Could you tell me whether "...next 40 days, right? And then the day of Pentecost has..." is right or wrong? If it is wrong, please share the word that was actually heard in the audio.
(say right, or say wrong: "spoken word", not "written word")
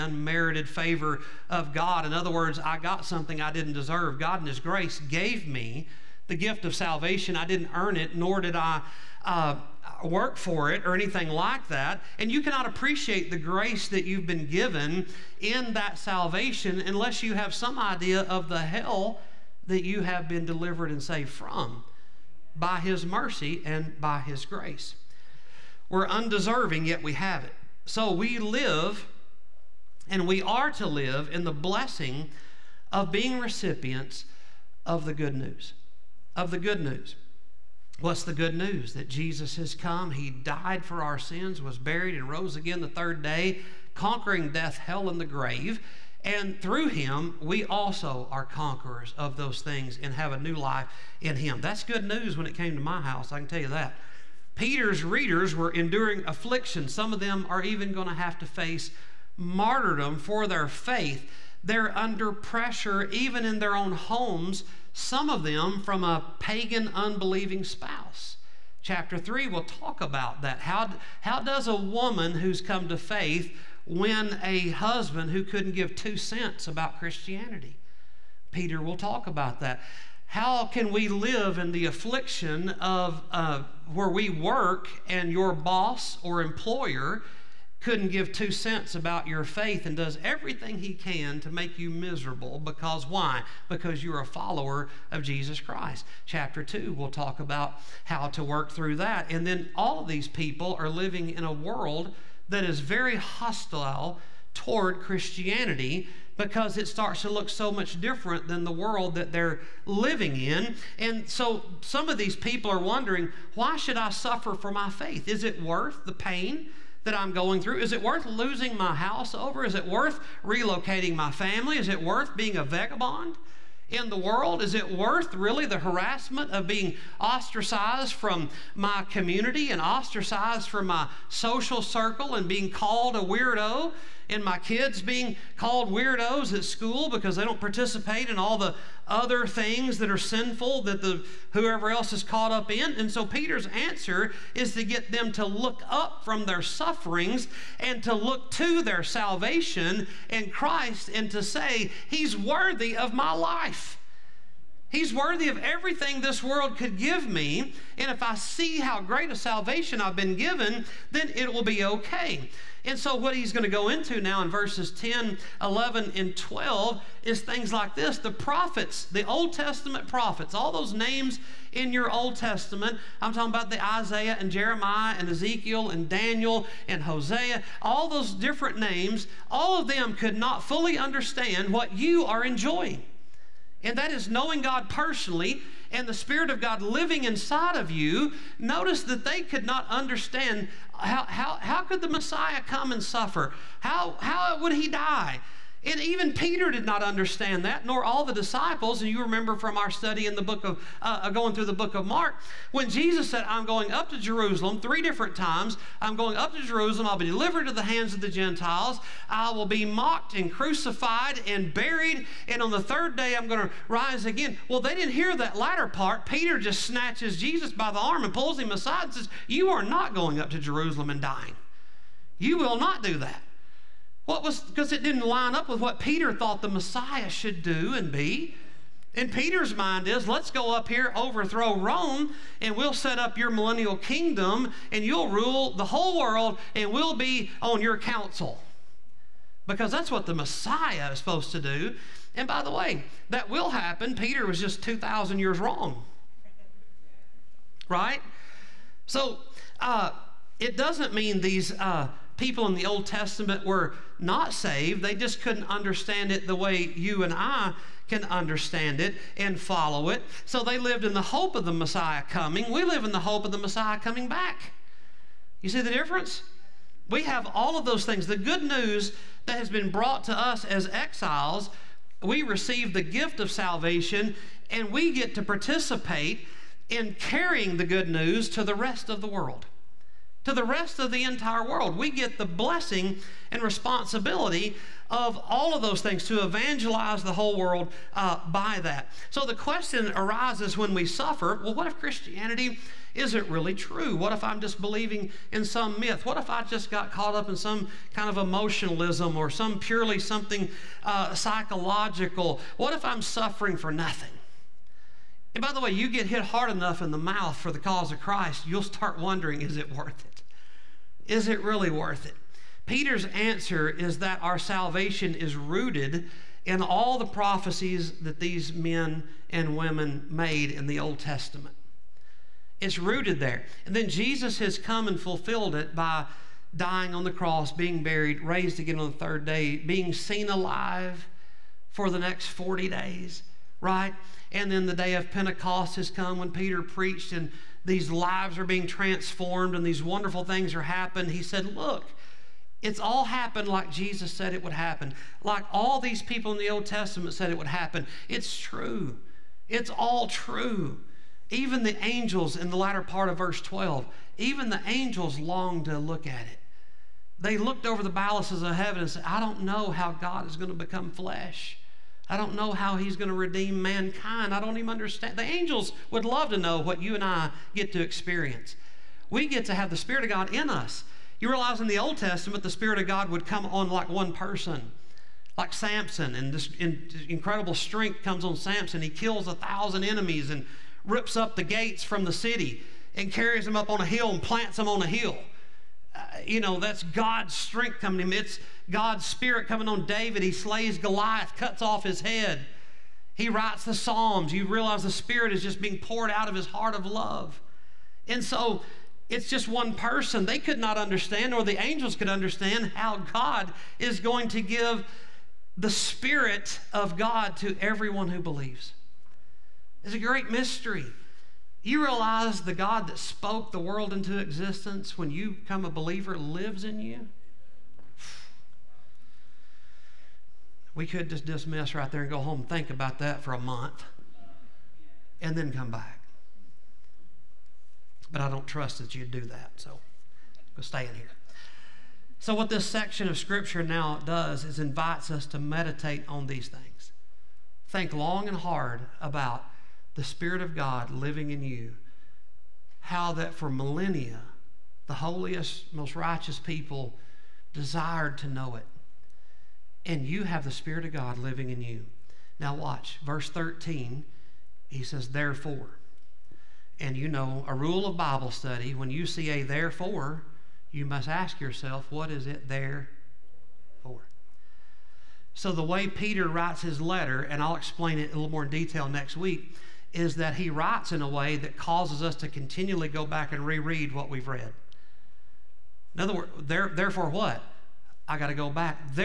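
right.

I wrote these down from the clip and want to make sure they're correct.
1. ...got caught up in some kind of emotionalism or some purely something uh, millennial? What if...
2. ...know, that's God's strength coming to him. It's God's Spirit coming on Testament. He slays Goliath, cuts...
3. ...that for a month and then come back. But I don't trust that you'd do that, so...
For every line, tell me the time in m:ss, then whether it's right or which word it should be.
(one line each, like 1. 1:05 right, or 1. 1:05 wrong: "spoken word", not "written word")
1. 4:56 wrong: "psychological", not "millennial"
2. 6:26 wrong: "David", not "Testament"
3. 7:03 right.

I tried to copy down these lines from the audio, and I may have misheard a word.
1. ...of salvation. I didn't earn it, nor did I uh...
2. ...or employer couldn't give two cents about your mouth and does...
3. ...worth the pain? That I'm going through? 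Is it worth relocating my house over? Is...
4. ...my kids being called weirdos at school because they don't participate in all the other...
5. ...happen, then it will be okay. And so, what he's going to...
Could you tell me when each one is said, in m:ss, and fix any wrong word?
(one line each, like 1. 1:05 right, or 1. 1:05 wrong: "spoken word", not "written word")
1. 0:06 right
2. 1:26 wrong: "faith", not "mouth"
3. 1:55 wrong: "losing", not "relocating"
4. 2:14 right
5. 2:40 wrong: "given", not "happen".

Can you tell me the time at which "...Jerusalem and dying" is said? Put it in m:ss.
3:40.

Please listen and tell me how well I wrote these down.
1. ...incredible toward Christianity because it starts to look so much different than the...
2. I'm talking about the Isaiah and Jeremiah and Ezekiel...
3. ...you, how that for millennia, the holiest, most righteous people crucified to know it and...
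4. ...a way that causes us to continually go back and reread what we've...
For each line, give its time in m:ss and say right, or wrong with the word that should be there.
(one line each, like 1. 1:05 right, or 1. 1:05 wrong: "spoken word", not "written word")
1. 1:43 wrong: "hostile", not "incredible"
2. 2:53 right
3. 7:21 wrong: "desired", not "crucified"
4. 7:51 right.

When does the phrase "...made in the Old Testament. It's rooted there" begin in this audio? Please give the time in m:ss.
5:20.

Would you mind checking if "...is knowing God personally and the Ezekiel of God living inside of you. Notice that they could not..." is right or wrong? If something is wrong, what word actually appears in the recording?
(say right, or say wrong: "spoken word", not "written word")
wrong: "Spirit", not "Ezekiel".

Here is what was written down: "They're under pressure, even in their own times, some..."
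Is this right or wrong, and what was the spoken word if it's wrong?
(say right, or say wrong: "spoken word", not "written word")
wrong: "homes", not "times".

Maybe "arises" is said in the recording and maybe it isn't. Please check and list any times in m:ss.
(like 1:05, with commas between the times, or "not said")
4:50.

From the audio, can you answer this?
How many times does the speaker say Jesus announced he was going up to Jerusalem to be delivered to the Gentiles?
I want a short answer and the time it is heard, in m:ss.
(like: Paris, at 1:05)
3, at 3:24.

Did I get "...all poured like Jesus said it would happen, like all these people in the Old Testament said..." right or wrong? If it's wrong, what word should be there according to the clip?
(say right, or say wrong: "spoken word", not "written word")
wrong: "happened", not "poured".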